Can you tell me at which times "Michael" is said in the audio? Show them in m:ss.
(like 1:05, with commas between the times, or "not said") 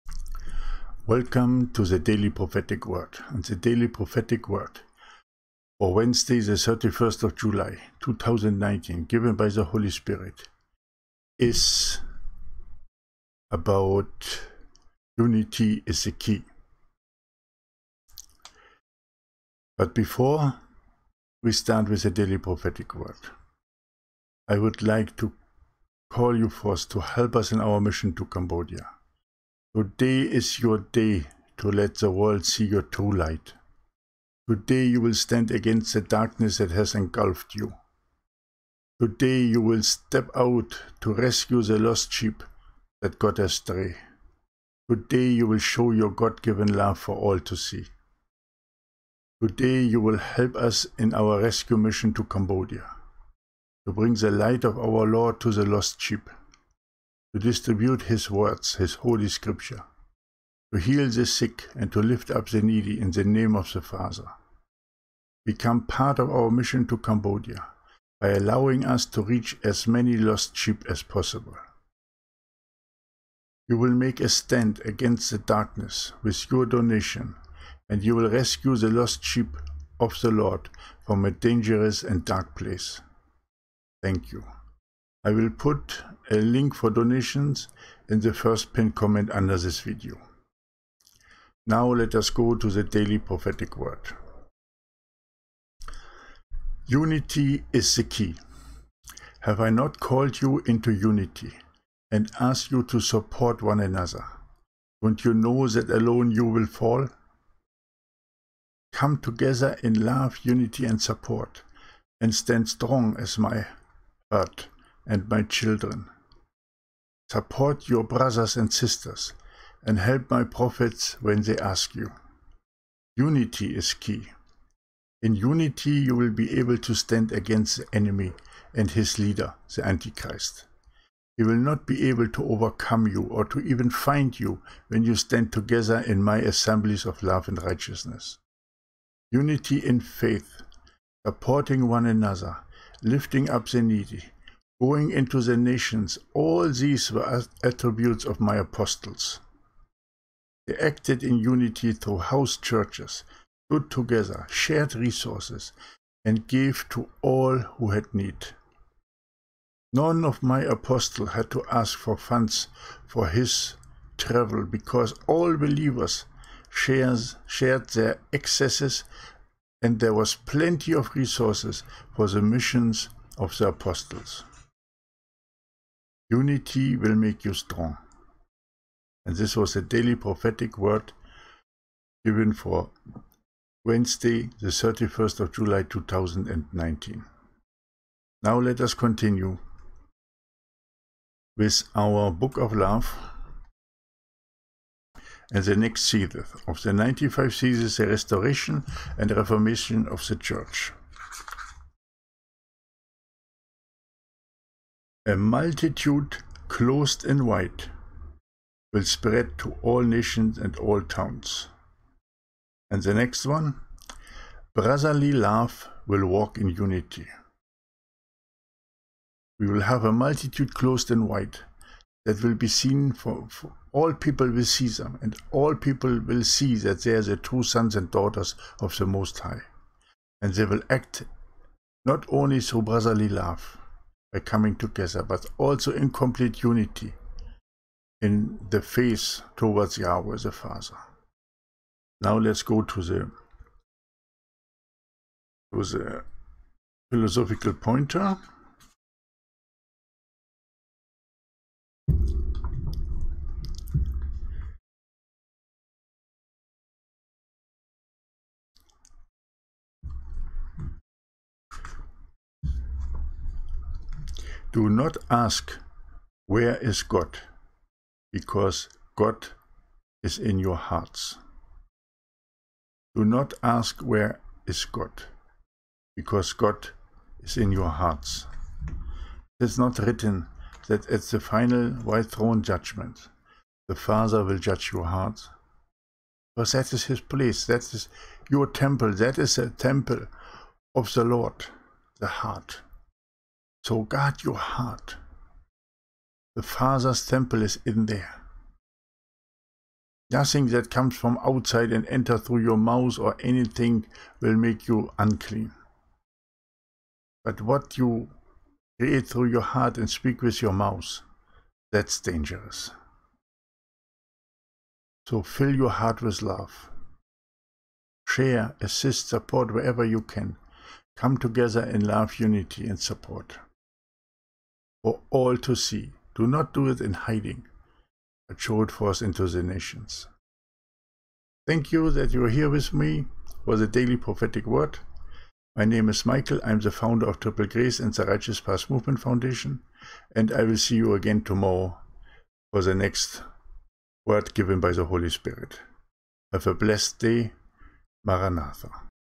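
5:36.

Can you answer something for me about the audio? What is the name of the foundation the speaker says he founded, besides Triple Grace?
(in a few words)
Righteous Path Movement Foundation.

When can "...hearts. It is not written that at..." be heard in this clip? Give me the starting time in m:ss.
4:37.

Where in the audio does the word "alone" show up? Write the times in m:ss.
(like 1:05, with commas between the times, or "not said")
1:45.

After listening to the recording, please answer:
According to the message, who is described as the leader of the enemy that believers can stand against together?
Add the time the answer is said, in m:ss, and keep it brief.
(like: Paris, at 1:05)
The Antichrist, at 2:09.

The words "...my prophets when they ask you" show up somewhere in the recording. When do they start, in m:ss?
2:00.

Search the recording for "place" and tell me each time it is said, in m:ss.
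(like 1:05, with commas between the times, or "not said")
1:22, 4:47.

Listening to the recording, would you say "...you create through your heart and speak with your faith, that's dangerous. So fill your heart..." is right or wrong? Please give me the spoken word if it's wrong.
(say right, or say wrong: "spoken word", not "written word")
wrong: "mouth", not "faith".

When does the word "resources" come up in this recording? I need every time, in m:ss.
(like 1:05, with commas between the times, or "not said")
2:34, 2:51.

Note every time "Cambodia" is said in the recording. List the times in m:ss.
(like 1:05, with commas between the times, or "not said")
0:28, 0:52, 1:06.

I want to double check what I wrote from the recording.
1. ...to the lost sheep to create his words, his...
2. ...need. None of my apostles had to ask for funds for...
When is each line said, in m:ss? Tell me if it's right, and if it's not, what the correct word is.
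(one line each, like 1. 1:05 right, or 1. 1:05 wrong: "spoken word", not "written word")
1. 0:55 wrong: "distribute", not "create"
2. 2:38 right.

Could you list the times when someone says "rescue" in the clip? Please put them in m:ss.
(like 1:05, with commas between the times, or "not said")
0:41, 0:51, 1:18.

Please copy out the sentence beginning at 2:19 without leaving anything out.
Unity in faith, supporting one another, lifting up the needy, going into the nations, all these were attributes of my apostles.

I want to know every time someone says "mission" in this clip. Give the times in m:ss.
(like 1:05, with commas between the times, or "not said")
0:27, 0:51, 1:06, 2:52.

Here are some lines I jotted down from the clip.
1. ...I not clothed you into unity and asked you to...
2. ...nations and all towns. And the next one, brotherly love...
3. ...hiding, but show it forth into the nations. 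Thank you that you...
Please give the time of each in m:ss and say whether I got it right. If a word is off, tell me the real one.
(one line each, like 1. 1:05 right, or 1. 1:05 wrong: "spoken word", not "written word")
1. 1:39 wrong: "called", not "clothed"
2. 3:30 right
3. 5:27 right.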